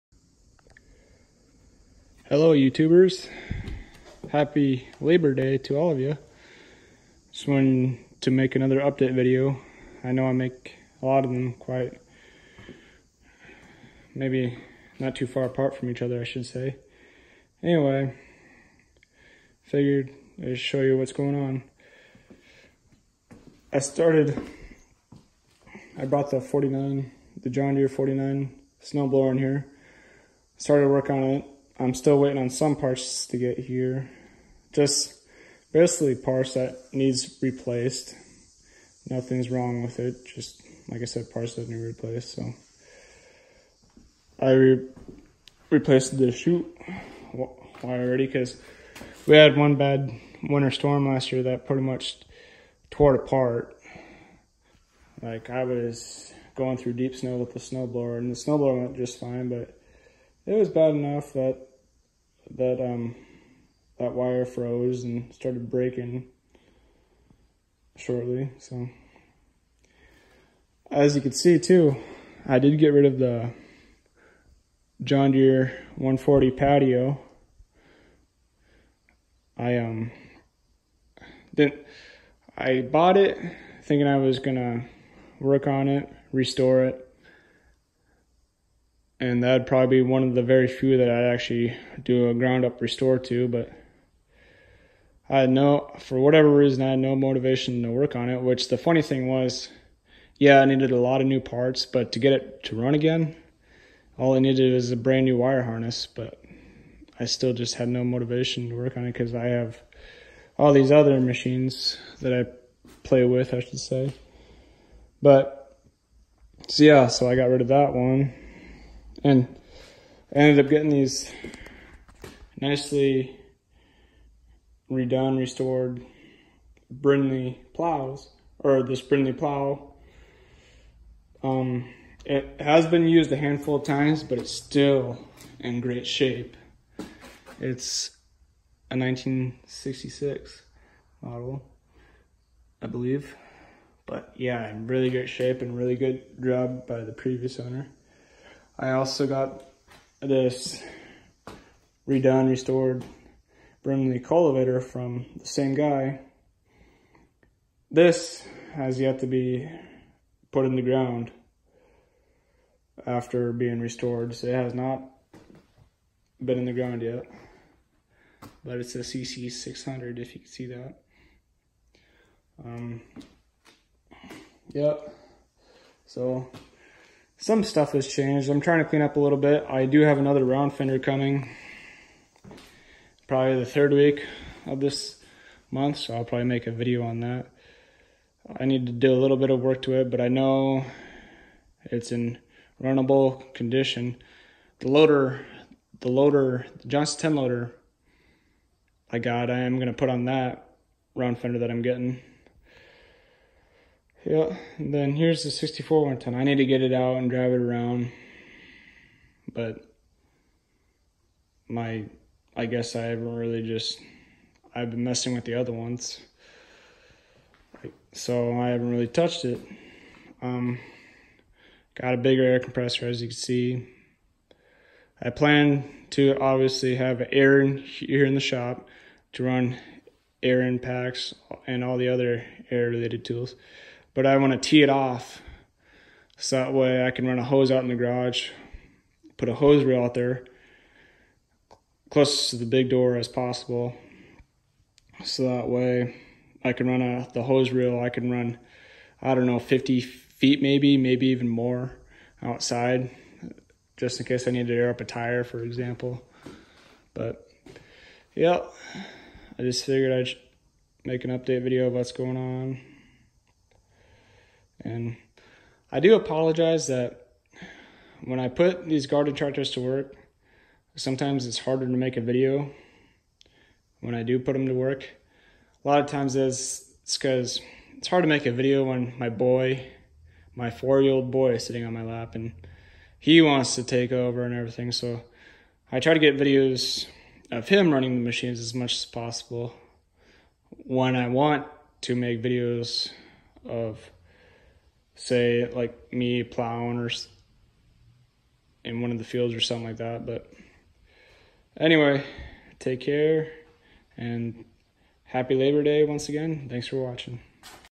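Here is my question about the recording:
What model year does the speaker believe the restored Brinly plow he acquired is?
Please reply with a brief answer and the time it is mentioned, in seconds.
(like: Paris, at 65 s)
1966, at 138 s.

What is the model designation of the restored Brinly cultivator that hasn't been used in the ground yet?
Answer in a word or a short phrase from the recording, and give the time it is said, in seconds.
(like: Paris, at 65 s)
CC600, at 168 s.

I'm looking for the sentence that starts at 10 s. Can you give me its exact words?
I know I make a lot of them quite, maybe not too far apart from each other I should say.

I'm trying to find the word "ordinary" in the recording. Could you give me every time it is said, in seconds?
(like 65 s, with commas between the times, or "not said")
not said.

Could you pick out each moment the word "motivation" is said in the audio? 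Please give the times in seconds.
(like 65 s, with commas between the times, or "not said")
97 s, 108 s.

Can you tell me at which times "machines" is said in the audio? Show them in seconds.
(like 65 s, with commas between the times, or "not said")
111 s, 288 s.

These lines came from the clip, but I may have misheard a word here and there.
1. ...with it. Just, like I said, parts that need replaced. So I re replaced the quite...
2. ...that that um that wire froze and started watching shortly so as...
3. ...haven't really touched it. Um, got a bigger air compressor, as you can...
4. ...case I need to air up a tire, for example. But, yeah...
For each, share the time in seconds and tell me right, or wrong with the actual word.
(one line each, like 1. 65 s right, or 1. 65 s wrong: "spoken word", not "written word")
1. 39 s wrong: "chute", not "quite"
2. 61 s wrong: "breaking", not "watching"
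3. 218 s right
4. 254 s right.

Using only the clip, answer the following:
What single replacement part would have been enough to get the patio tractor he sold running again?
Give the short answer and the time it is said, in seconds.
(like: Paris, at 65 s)
wire harness, at 105 s.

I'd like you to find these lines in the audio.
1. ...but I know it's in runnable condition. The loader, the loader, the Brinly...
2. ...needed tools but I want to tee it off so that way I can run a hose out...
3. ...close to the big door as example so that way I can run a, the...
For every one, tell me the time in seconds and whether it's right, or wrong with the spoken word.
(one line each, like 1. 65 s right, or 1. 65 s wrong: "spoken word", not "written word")
1. 190 s wrong: "Johnson", not "Brinly"
2. 232 s wrong: "related", not "needed"
3. 242 s wrong: "possible", not "example".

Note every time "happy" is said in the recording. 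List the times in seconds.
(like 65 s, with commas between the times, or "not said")
4 s, 305 s.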